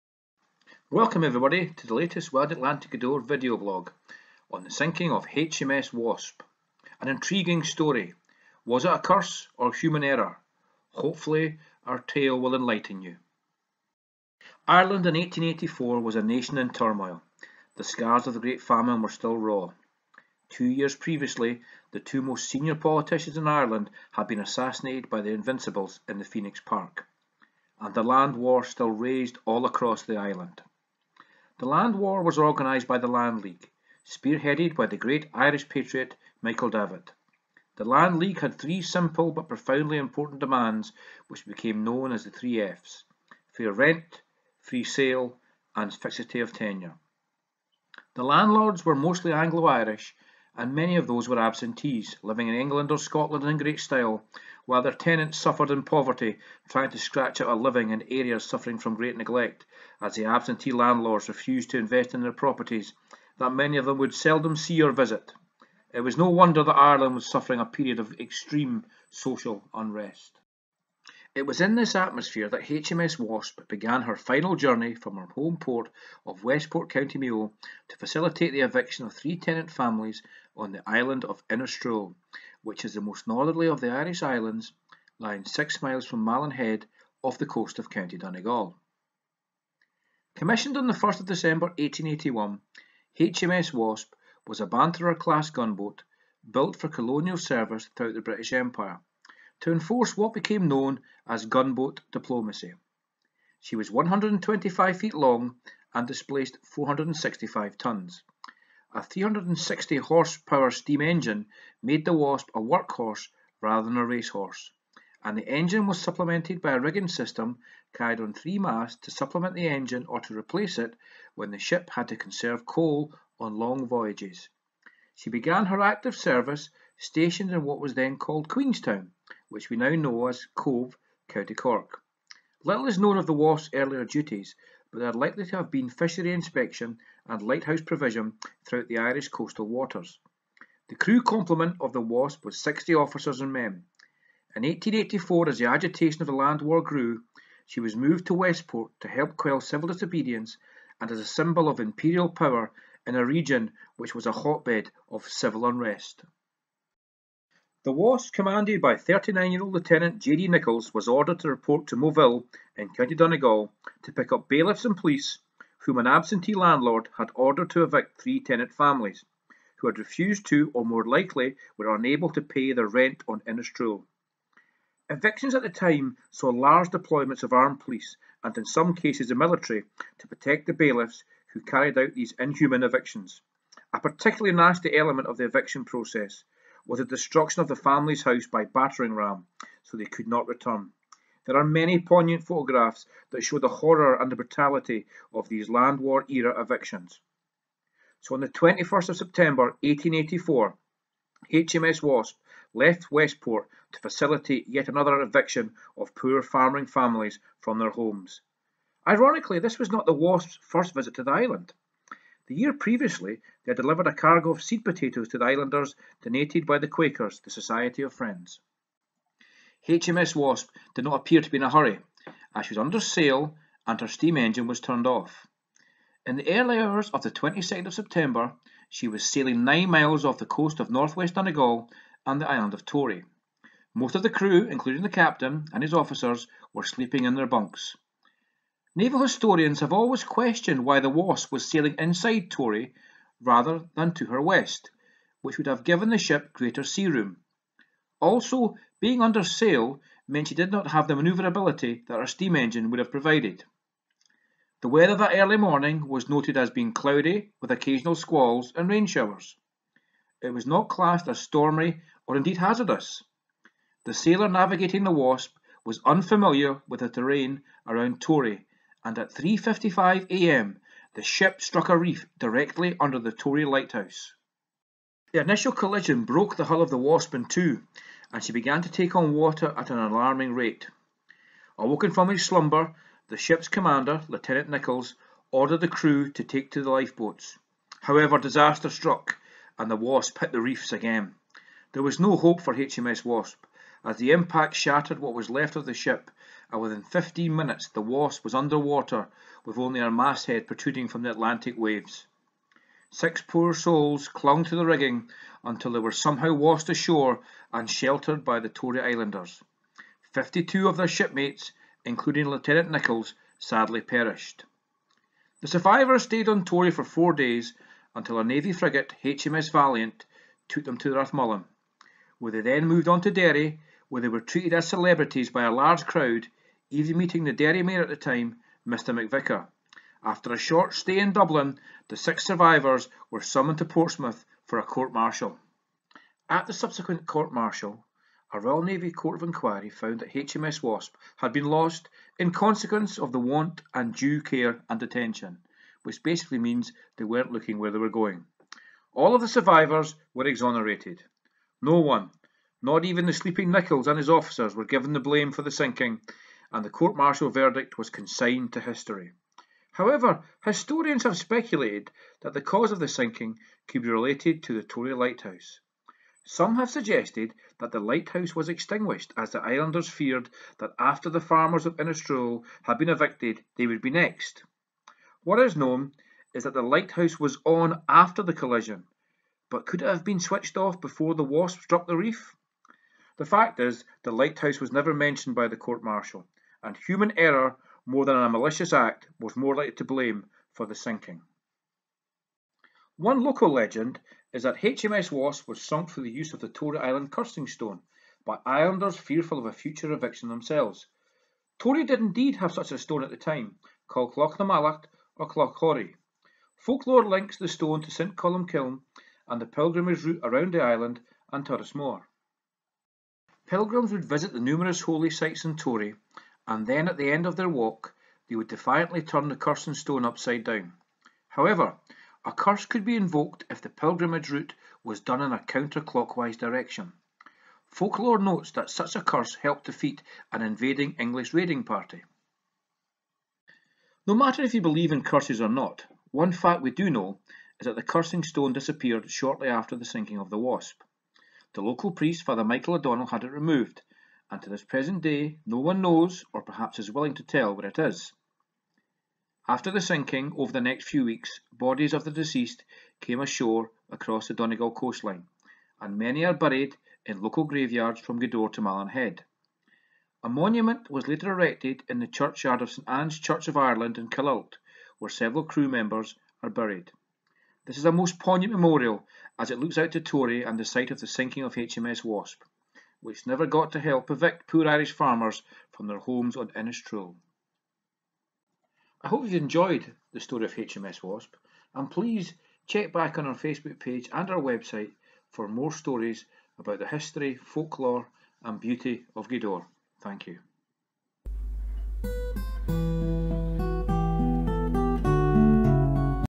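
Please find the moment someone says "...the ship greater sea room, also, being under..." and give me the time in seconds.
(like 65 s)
246 s.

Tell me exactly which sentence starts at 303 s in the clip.
Six poor souls clung to the rigging until they were somehow washed ashore and sheltered by the Tory Islanders.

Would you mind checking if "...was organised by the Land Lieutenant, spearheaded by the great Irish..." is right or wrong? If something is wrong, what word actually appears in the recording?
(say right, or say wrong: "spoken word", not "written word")
wrong: "League", not "Lieutenant".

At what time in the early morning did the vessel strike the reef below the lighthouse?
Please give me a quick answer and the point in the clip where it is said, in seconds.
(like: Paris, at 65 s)
3:55am, at 269 s.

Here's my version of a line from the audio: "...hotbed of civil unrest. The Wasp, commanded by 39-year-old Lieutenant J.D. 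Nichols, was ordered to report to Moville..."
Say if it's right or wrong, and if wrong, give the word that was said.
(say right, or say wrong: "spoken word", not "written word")
right.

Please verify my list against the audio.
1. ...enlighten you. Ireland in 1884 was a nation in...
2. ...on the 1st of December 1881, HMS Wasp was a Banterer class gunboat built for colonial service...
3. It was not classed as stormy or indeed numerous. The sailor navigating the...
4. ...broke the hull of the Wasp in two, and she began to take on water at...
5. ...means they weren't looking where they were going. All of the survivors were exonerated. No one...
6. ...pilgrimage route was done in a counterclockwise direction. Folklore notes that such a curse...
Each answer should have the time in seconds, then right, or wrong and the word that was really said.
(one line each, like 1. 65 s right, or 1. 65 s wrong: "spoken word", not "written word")
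1. 12 s right
2. 90 s right
3. 260 s wrong: "hazardous", not "numerous"
4. 276 s right
5. 346 s right
6. 423 s right.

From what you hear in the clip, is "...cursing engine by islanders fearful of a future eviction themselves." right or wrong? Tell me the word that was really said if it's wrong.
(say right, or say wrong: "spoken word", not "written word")
wrong: "stone", not "engine".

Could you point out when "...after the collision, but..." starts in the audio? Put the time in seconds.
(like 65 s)
378 s.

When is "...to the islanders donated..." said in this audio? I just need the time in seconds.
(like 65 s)
215 s.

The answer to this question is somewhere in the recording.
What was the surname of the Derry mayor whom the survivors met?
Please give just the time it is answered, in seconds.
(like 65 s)
328 s.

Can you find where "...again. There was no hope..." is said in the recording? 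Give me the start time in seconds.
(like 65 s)
290 s.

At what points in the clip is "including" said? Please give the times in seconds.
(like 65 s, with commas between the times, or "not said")
234 s, 312 s.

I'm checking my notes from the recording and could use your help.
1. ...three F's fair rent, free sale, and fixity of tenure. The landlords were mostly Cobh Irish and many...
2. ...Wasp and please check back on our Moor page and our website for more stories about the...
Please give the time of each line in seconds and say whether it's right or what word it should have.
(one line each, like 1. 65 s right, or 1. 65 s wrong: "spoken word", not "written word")
1. 42 s wrong: "Anglo", not "Cobh"
2. 481 s wrong: "Facebook", not "Moor".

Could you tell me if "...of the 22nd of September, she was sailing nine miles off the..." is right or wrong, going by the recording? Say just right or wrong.
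right.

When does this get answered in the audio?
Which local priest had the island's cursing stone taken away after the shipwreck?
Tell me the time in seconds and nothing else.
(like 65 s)
442 s.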